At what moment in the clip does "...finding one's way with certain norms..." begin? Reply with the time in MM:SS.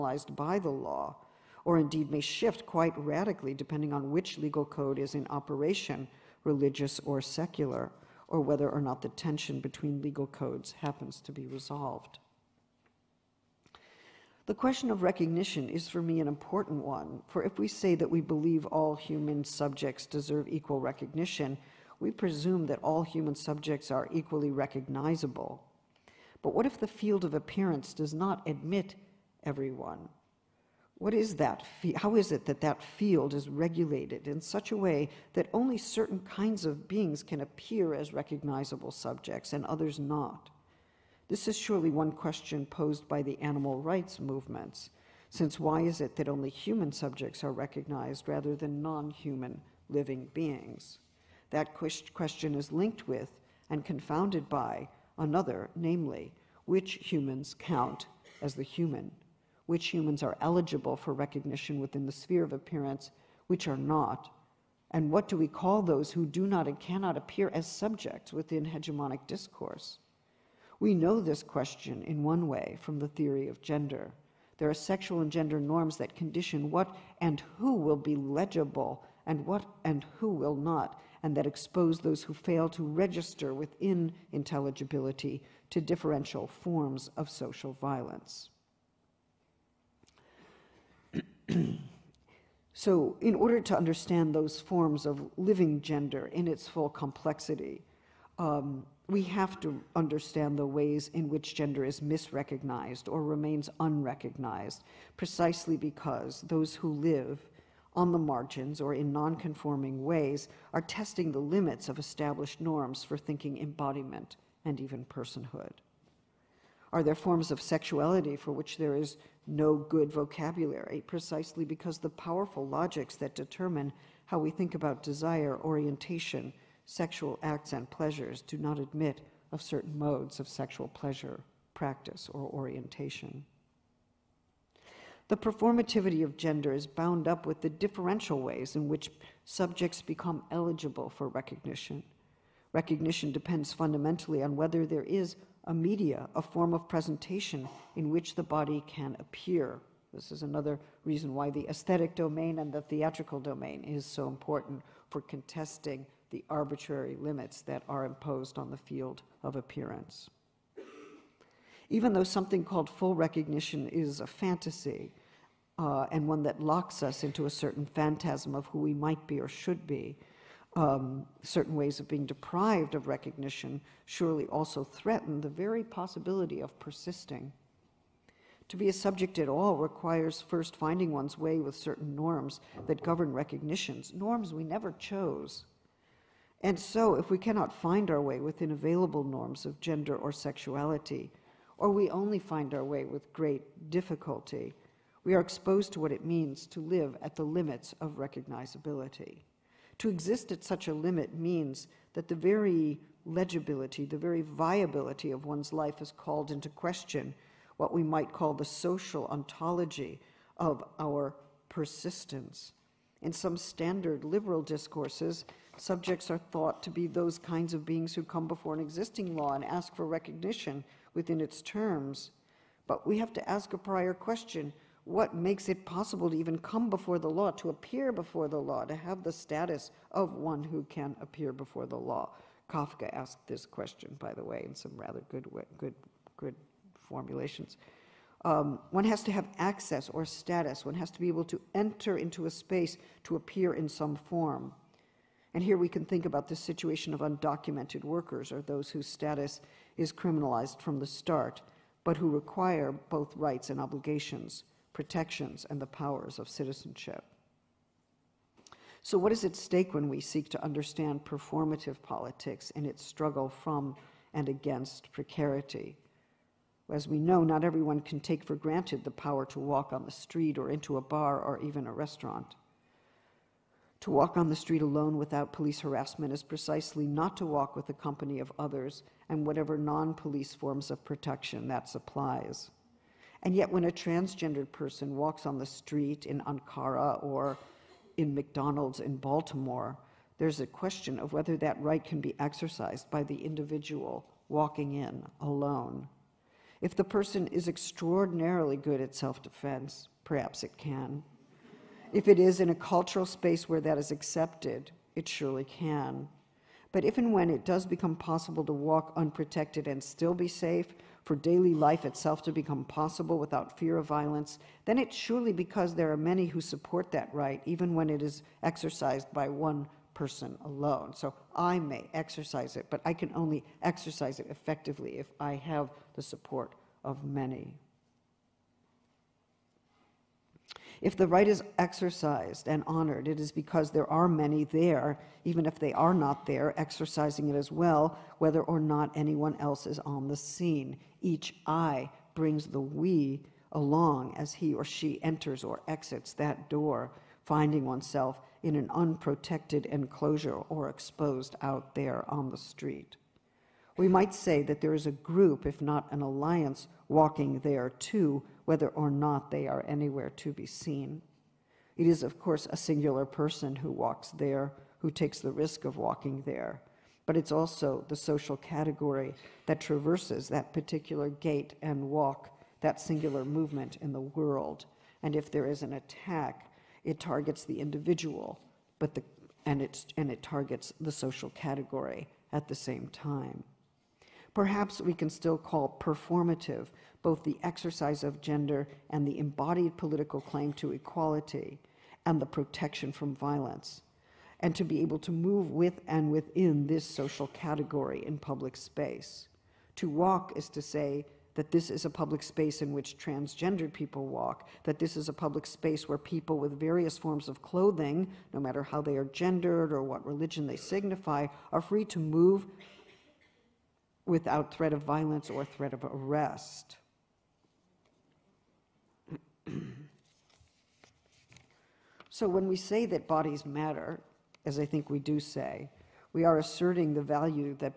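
03:00.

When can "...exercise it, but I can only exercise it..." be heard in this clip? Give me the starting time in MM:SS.
05:22.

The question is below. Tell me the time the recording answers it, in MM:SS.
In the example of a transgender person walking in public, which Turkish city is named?
04:46.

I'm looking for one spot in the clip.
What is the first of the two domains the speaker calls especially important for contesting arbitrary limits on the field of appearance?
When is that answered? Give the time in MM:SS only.
02:31.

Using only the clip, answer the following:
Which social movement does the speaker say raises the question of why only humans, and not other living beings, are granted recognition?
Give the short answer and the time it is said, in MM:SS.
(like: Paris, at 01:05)
animal rights movements, at 00:43.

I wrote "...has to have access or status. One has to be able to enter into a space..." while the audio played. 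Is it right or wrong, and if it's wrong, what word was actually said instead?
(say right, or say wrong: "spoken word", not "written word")
right.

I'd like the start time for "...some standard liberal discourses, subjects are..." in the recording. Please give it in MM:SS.
03:33.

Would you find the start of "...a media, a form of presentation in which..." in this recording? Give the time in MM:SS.
02:25.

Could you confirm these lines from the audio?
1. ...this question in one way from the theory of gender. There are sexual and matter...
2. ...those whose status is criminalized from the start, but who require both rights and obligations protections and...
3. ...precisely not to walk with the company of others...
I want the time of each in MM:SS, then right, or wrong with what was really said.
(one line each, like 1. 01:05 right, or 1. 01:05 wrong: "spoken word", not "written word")
1. 01:11 wrong: "gender", not "matter"
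2. 04:08 right
3. 04:36 right.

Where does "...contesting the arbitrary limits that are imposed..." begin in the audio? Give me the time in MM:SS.
02:35.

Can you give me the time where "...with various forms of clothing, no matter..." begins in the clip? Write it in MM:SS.
06:46.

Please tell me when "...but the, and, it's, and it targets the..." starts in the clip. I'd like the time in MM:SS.
06:18.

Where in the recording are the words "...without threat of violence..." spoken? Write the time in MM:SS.
06:54.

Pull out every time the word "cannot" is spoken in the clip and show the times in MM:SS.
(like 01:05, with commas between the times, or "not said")
01:06, 03:07.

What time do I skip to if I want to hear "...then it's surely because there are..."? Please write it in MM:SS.
05:14.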